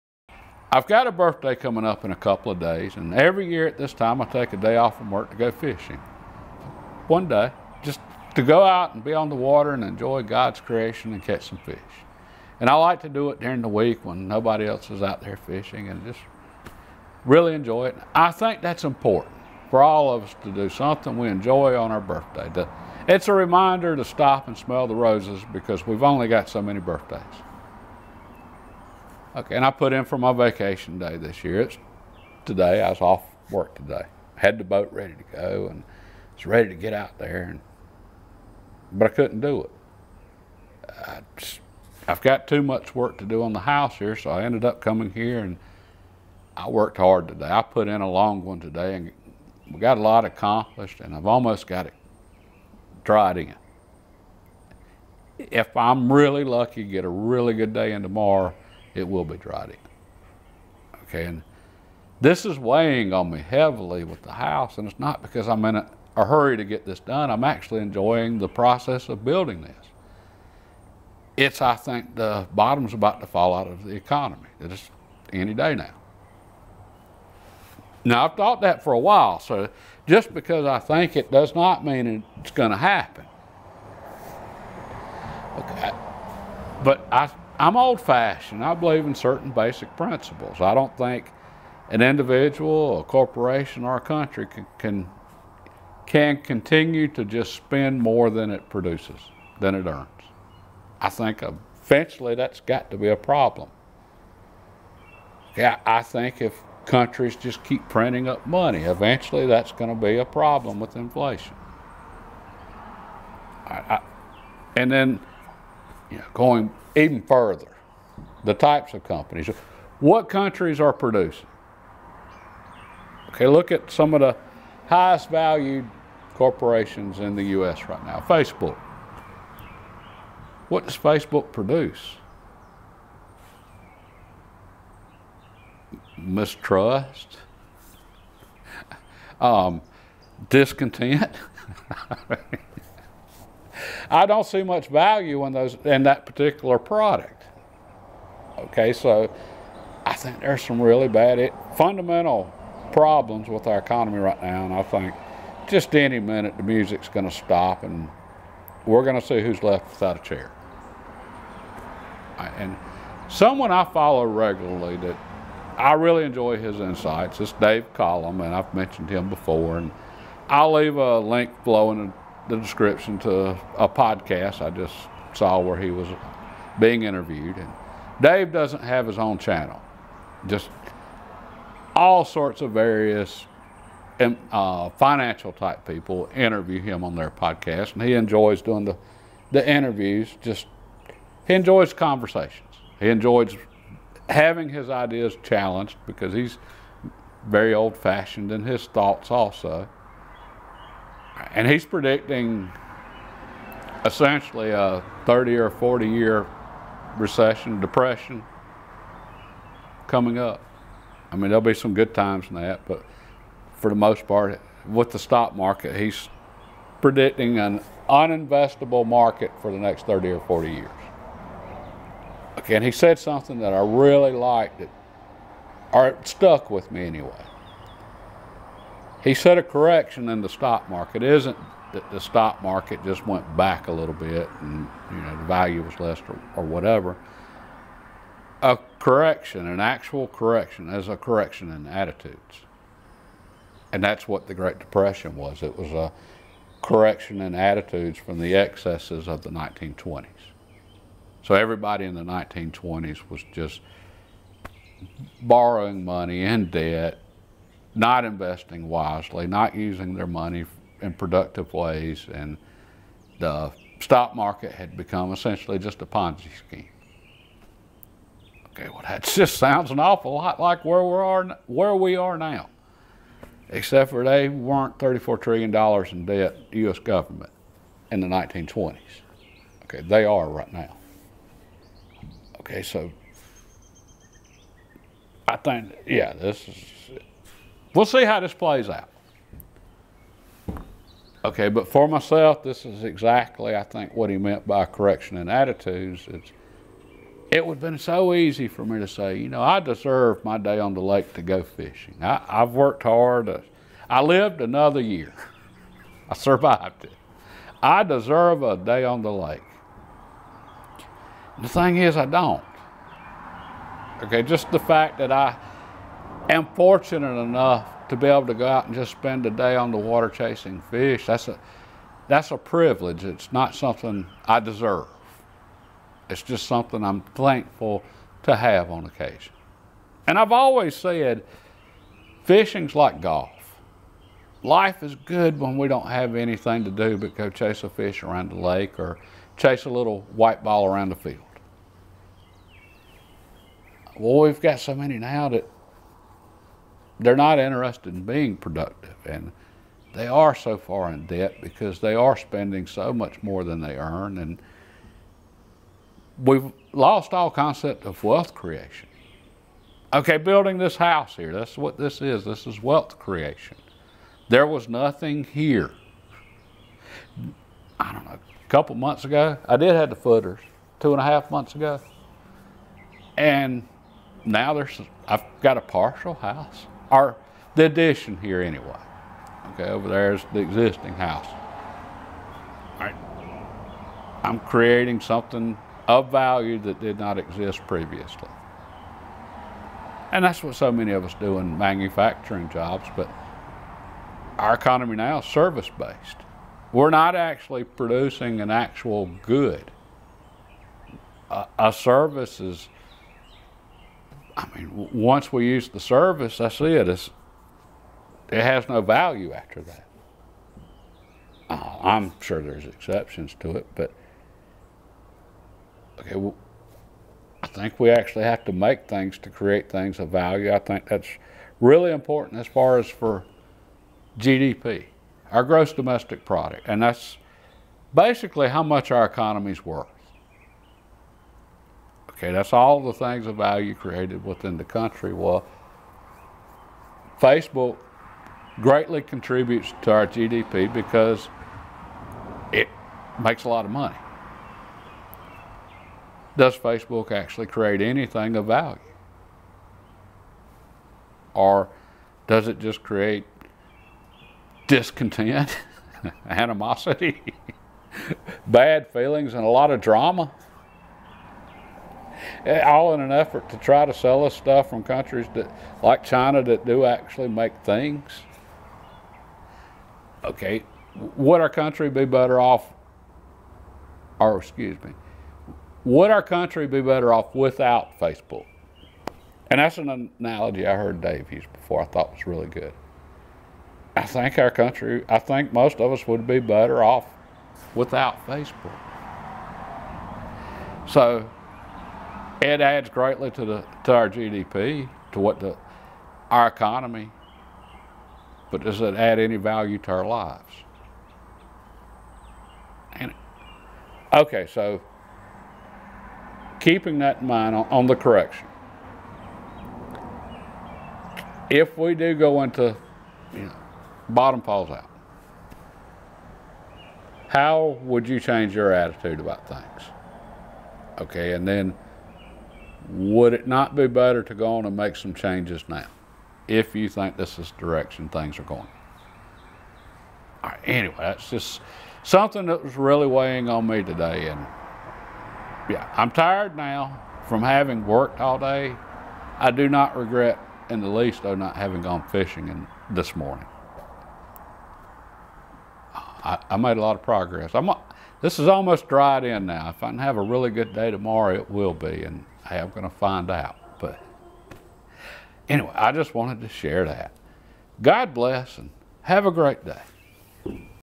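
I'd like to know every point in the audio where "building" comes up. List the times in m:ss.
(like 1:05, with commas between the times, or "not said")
1:09, 6:00.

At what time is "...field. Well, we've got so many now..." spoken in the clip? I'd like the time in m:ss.
5:41.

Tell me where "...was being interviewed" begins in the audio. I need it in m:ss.
2:55.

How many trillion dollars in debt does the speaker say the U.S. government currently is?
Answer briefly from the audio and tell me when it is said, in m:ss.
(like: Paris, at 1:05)
34 trillion, at 4:34.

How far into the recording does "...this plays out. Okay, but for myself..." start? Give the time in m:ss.
4:48.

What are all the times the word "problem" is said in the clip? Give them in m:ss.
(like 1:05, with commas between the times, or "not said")
1:43, 1:50, 2:32.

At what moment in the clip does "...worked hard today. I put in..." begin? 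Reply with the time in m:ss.
0:46.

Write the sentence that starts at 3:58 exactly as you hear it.
A correction, an actual correction, is a correction in attitudes.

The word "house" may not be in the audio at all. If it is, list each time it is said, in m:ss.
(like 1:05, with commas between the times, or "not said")
0:43, 1:04, 6:00, 6:16, 6:21.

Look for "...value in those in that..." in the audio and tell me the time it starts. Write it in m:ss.
2:24.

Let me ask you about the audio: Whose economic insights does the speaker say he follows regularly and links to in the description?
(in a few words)
Dave Collum.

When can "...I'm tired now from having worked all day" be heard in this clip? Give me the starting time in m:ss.
8:56.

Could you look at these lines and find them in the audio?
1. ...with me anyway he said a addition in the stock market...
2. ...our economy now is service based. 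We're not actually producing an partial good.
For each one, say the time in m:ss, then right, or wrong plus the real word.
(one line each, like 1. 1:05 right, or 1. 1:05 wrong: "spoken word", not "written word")
1. 3:46 wrong: "correction", not "addition"
2. 6:34 wrong: "actual", not "partial".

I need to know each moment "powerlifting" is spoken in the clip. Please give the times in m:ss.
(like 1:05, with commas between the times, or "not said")
not said.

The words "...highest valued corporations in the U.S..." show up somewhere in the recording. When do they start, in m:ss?
2:04.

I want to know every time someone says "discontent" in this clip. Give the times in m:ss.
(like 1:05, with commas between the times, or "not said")
2:20, 7:34.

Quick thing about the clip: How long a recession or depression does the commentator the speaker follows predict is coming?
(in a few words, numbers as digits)
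30 or 40 years.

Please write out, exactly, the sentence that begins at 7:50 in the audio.
Okay, would our country be better off, or excuse me, would our country be better off without Facebook?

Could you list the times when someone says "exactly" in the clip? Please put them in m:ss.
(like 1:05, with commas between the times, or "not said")
4:53.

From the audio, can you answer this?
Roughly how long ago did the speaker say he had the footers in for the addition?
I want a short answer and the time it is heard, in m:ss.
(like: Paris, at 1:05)
2 and a half months, at 6:10.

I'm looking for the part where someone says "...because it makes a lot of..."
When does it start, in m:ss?
7:20.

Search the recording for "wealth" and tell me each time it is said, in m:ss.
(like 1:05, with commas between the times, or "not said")
5:58, 6:02.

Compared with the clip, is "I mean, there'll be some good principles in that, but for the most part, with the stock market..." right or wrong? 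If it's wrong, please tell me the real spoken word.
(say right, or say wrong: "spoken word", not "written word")
wrong: "times", not "principles".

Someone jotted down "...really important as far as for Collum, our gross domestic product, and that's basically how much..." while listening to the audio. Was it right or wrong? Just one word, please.
wrong.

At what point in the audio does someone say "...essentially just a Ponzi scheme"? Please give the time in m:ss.
4:25.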